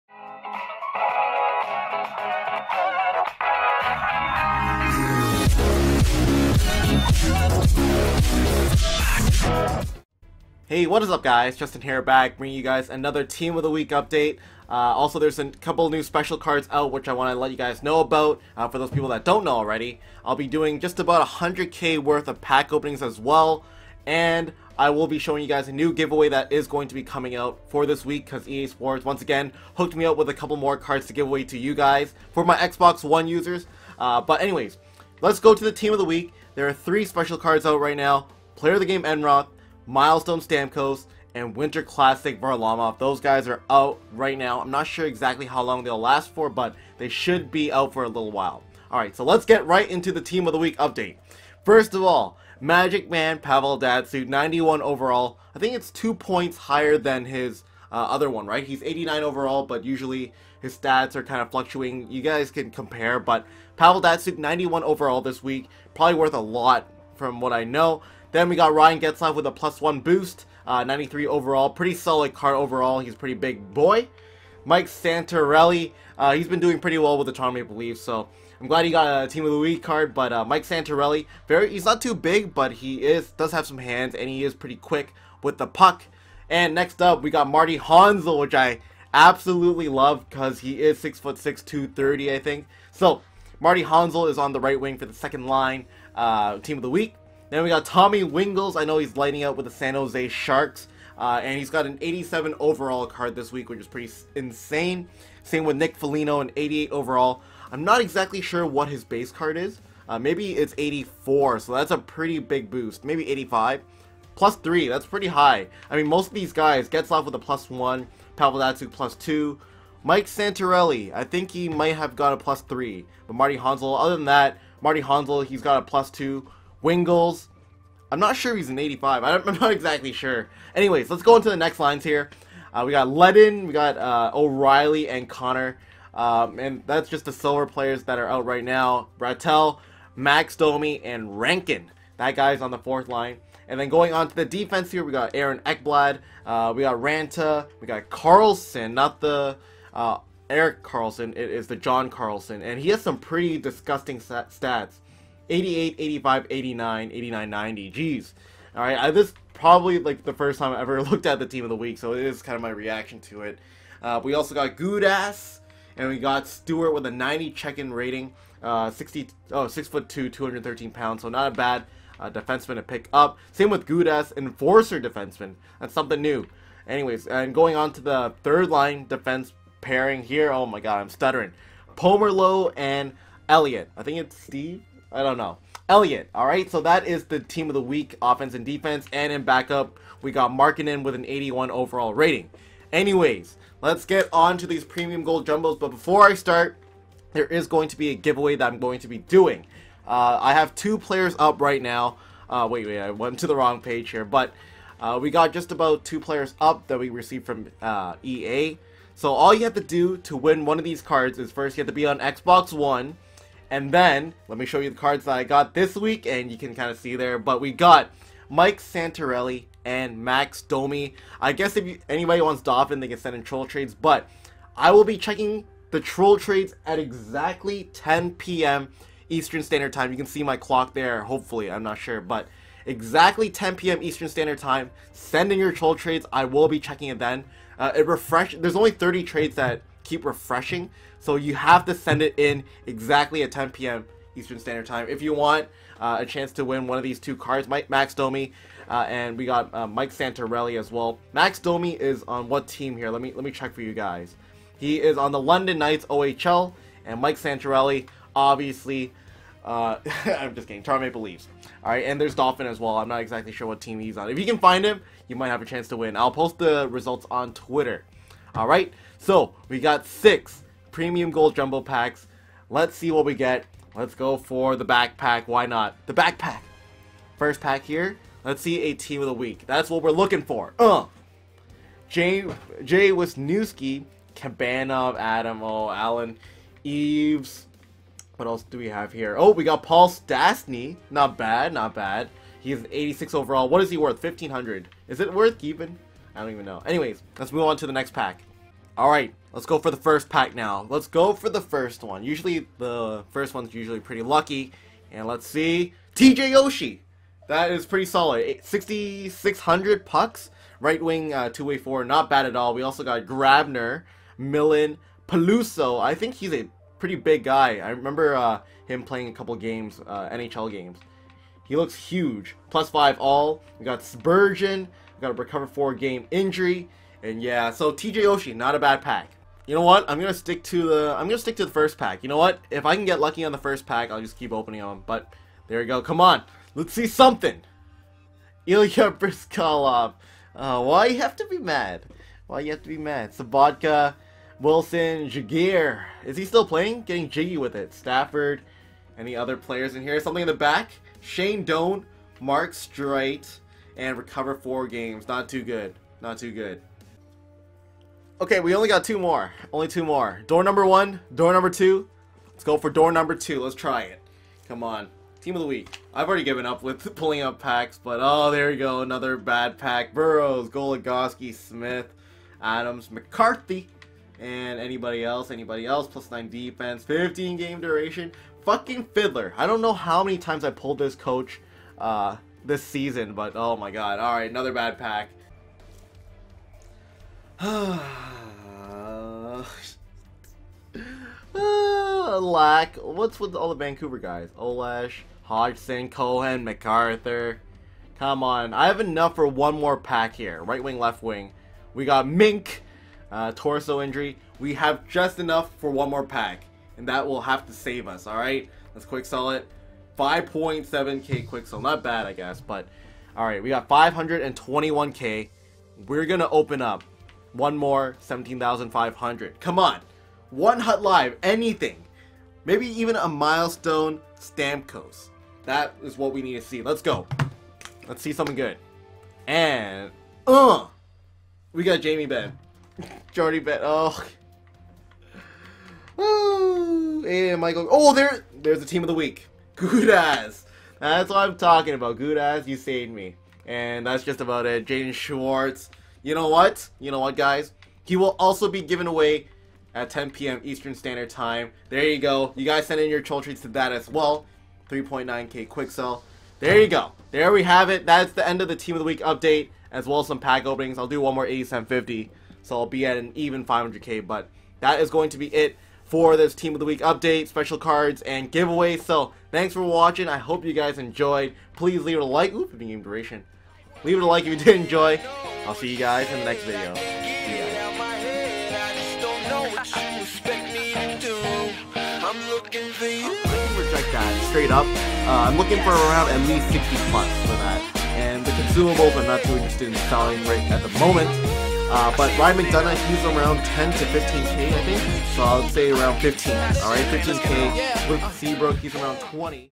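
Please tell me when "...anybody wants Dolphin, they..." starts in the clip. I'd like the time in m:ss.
3:42.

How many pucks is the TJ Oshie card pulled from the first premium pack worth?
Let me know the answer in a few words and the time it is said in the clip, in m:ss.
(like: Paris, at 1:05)
6,600, at 5:08.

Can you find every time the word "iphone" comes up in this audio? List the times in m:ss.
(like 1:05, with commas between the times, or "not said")
not said.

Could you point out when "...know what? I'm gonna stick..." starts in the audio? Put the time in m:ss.
5:29.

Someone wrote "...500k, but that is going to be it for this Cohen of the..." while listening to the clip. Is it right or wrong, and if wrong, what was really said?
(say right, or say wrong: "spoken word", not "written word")
wrong: "Team", not "Cohen".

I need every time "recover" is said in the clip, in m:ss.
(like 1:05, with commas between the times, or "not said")
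5:25, 5:54.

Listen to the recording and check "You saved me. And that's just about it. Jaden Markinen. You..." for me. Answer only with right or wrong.
wrong.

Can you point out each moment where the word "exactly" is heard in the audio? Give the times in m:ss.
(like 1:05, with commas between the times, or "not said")
0:45, 1:48, 2:09, 3:46, 3:52, 4:02, 4:23.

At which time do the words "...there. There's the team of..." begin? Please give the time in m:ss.
7:18.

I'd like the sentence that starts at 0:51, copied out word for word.
First of all, Magic Man Pavel Datsyuk, 91 overall.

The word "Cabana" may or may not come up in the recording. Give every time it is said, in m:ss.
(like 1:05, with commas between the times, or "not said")
4:44.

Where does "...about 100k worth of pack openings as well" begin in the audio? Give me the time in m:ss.
0:20.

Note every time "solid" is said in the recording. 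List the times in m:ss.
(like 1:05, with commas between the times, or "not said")
1:11, 5:08.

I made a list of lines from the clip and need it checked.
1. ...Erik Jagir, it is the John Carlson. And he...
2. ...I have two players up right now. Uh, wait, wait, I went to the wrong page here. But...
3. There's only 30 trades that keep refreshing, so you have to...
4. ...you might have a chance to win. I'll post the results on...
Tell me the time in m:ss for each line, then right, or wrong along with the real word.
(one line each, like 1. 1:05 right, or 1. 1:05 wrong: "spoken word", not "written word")
1. 2:30 wrong: "Karlsson", not "Jagir"
2. 3:20 right
3. 3:58 right
4. 4:25 right.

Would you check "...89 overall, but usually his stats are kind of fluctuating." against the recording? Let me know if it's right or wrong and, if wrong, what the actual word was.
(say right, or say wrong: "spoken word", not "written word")
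right.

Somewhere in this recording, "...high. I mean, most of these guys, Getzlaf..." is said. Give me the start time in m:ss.
1:55.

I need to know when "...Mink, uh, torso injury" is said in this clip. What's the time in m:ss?
6:42.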